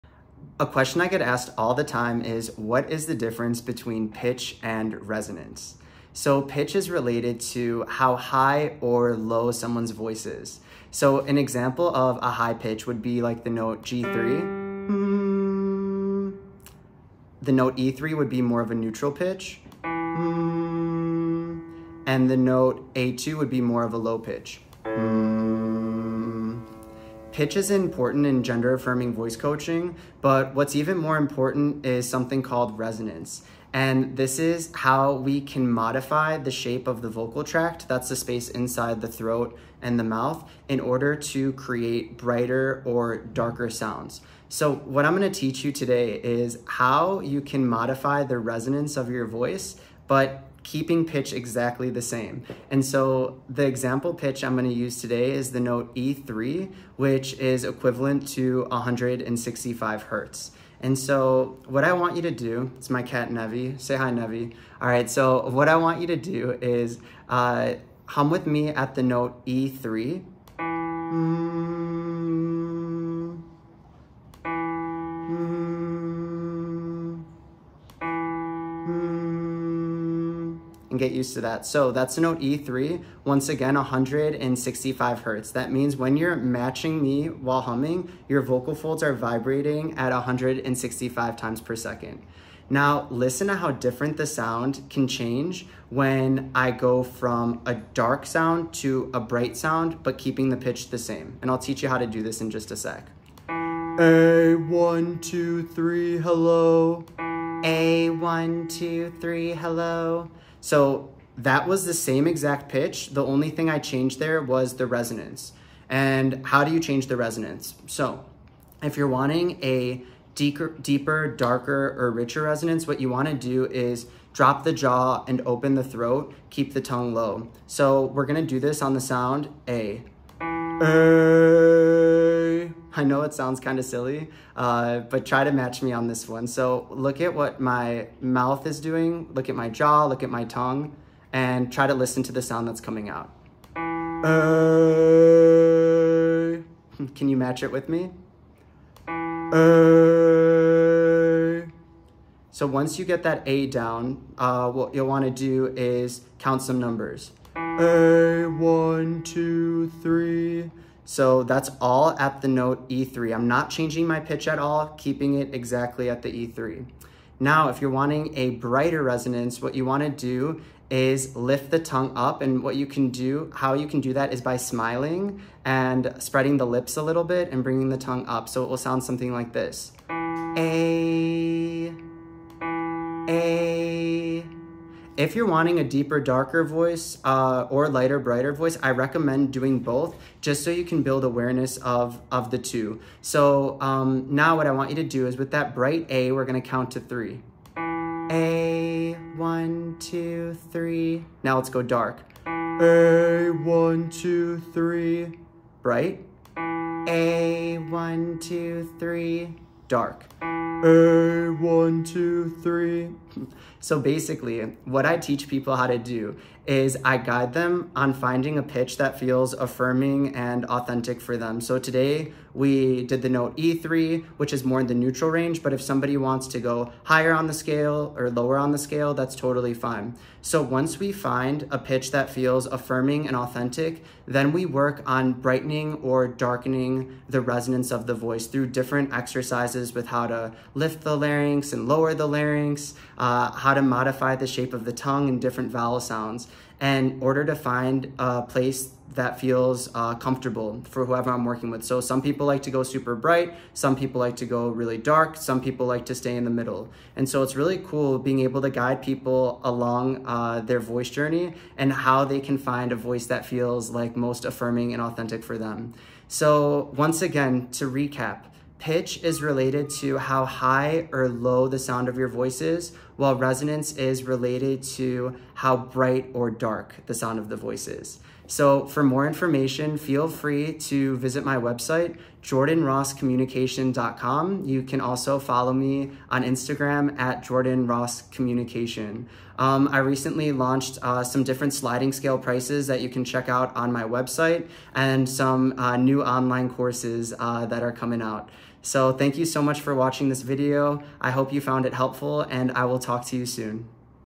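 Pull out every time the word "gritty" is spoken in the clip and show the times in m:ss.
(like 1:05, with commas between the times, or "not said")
not said.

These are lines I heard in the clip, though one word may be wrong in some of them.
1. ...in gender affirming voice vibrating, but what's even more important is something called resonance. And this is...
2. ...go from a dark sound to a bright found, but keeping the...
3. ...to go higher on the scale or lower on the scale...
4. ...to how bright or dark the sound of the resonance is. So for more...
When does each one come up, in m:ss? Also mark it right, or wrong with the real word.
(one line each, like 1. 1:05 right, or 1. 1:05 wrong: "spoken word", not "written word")
1. 0:28 wrong: "coaching", not "vibrating"
2. 1:36 wrong: "sound", not "found"
3. 3:46 right
4. 4:34 wrong: "voice", not "resonance".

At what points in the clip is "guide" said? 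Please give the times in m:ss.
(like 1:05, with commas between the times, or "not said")
3:37, 4:18.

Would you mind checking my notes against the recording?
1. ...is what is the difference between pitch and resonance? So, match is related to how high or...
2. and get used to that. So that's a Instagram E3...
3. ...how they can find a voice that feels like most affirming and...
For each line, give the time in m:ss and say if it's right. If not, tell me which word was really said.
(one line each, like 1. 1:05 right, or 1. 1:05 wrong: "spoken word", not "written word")
1. 0:02 wrong: "pitch", not "match"
2. 1:20 wrong: "Note", not "Instagram"
3. 4:21 right.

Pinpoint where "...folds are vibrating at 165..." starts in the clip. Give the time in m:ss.
1:28.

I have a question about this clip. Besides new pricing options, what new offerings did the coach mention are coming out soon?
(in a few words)
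online courses.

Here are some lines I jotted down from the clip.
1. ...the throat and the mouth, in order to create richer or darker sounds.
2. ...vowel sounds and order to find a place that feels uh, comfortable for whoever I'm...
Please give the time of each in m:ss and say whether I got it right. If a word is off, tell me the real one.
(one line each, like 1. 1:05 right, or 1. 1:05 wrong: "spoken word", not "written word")
1. 0:38 wrong: "brighter", not "richer"
2. 4:05 right.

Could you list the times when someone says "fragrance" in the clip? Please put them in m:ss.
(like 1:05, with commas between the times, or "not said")
not said.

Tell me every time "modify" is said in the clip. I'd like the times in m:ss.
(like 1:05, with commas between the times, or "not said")
0:35, 0:47, 4:03.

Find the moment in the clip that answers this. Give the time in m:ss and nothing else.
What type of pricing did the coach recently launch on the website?
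4:51.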